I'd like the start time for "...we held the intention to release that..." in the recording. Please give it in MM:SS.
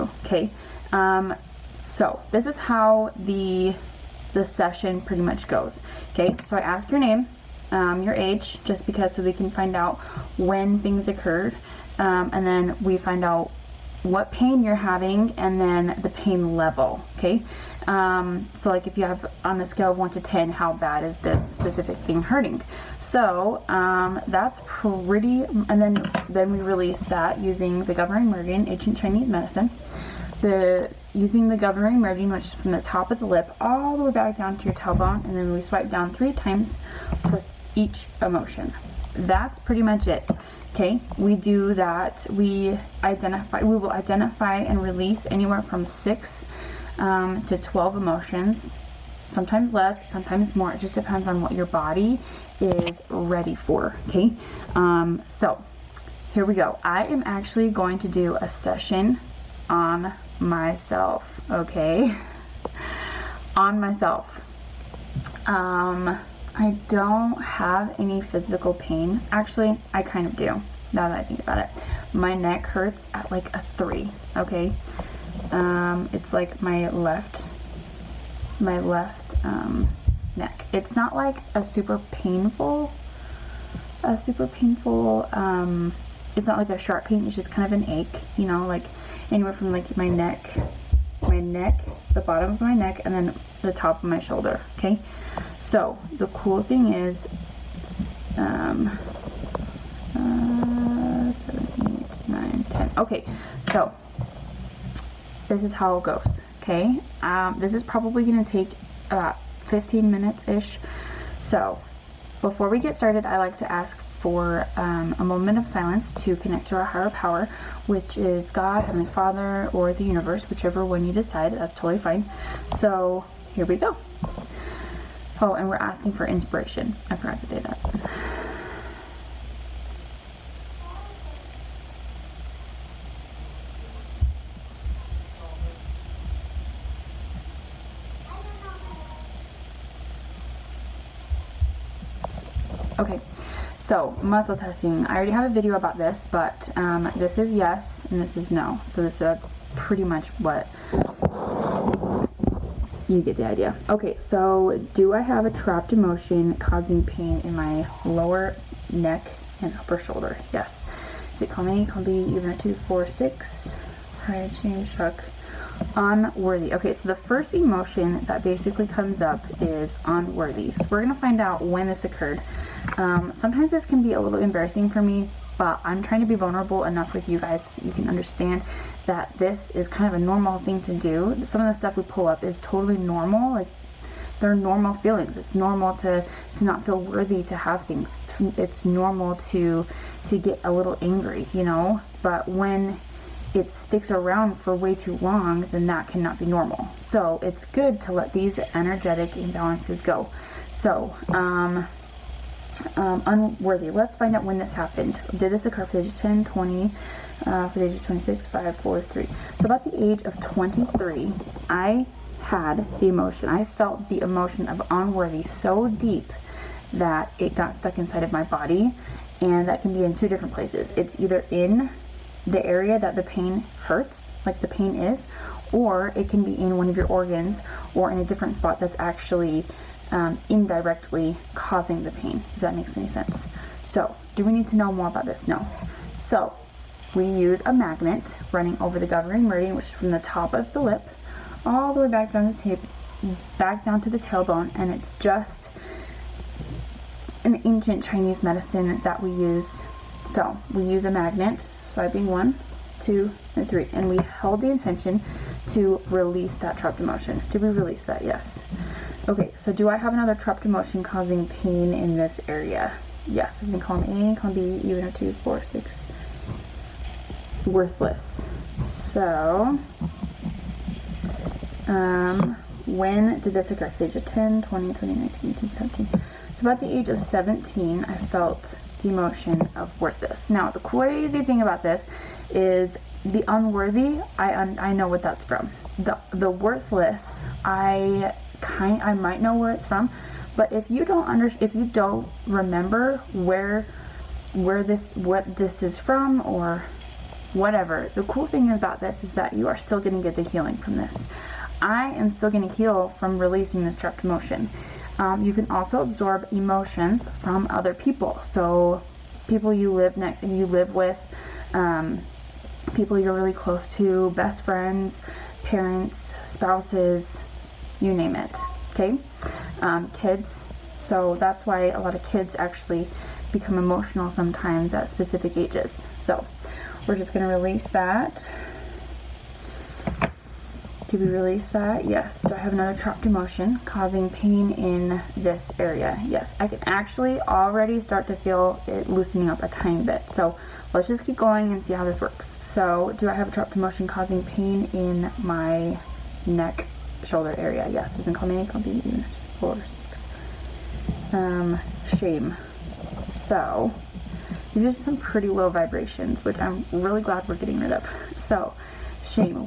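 04:14.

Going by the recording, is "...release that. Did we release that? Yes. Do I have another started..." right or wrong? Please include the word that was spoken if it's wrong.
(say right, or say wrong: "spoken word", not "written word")
wrong: "trapped", not "started".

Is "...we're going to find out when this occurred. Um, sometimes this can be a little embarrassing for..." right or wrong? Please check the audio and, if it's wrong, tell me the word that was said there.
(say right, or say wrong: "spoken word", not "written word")
right.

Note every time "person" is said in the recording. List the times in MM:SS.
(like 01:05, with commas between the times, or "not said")
not said.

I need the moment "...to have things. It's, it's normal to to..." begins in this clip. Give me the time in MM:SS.
03:07.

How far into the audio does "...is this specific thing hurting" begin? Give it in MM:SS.
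00:21.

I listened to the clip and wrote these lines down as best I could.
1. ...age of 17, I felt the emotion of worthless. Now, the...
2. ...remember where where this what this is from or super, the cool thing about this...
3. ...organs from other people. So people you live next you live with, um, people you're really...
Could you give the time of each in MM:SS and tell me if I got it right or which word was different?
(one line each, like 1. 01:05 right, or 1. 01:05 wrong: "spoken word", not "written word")
1. 04:36 right
2. 04:52 wrong: "whatever", not "super"
3. 05:06 wrong: "emotions", not "organs".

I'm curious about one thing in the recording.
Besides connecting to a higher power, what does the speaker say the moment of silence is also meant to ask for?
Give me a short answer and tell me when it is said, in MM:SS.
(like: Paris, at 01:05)
inspiration, at 02:06.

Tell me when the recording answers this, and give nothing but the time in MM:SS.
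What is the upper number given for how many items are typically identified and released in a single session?
00:47.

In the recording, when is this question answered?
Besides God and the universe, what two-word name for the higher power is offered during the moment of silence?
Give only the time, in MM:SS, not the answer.
01:58.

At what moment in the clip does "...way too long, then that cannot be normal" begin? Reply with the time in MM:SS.
03:14.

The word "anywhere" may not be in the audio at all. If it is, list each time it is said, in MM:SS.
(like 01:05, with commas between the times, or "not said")
00:45, 01:29.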